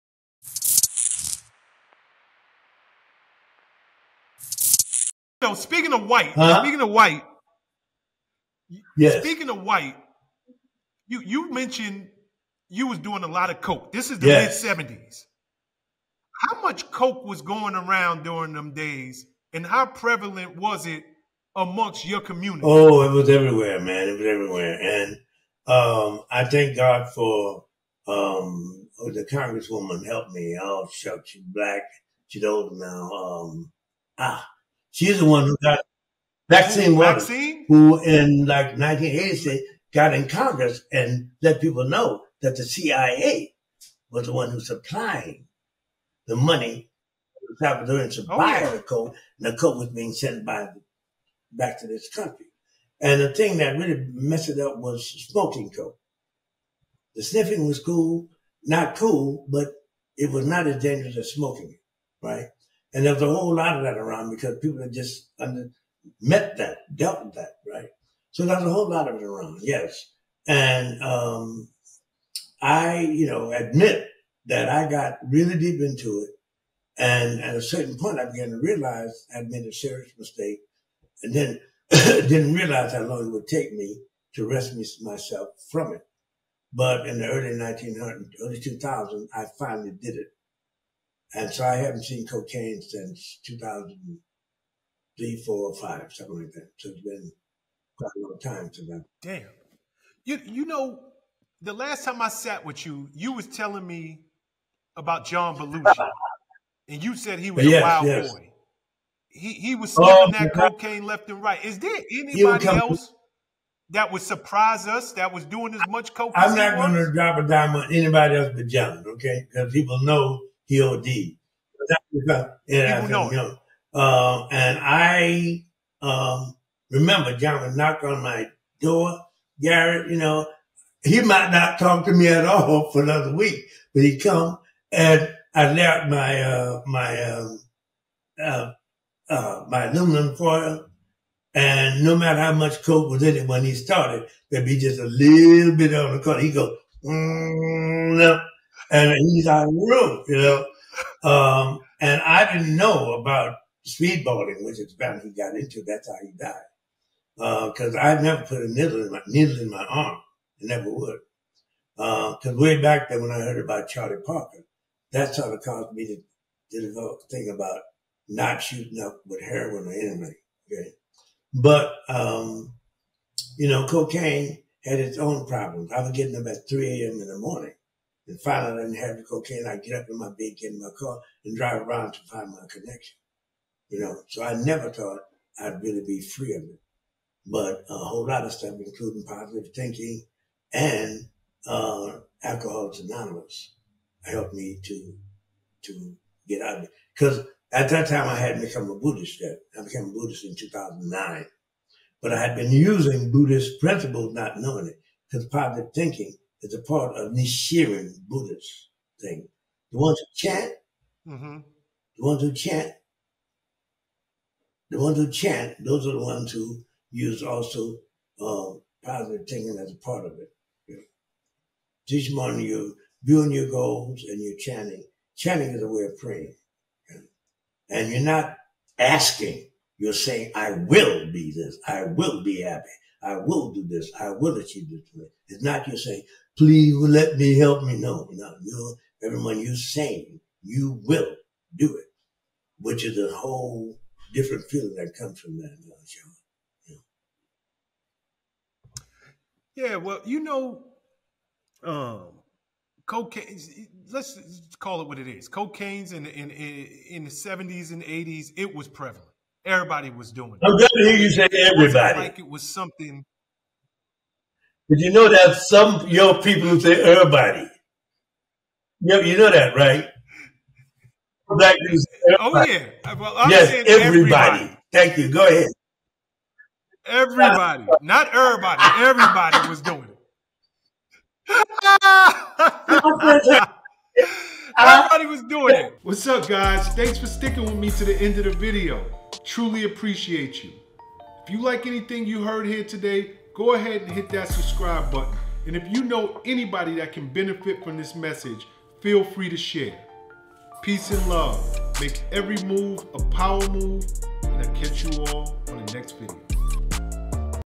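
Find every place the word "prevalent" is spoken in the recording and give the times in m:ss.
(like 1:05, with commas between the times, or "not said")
0:19, 4:18.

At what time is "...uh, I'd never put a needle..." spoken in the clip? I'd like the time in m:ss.
2:37.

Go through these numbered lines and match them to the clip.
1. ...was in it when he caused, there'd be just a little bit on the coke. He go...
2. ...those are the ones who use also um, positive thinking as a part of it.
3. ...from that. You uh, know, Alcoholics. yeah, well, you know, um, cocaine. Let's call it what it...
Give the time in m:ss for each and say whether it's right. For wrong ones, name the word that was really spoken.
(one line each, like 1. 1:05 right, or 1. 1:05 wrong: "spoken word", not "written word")
1. 2:23 wrong: "started", not "caused"
2. 3:35 right
3. 4:05 wrong: "Yeah", not "Alcoholics".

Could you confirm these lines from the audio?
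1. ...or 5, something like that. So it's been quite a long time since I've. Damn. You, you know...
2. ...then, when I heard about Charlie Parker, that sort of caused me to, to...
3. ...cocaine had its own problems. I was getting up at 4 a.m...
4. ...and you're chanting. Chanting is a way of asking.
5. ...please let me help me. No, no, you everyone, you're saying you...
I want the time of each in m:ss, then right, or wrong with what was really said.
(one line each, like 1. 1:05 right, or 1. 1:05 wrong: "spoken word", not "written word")
1. 1:35 right
2. 2:43 right
3. 2:53 wrong: "3", not "4"
4. 3:44 wrong: "praying", not "asking"
5. 3:56 right.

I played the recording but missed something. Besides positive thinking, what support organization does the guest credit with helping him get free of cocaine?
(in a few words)
Alcoholics Anonymous.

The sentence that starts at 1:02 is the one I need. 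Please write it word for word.
And there was a whole lot of that around because people had just under, met that, dealt with that, right?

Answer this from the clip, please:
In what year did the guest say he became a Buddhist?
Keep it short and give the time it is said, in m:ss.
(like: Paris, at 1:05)
2009, at 3:20.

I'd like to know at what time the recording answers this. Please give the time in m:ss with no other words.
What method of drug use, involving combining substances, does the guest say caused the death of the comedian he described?
2:33.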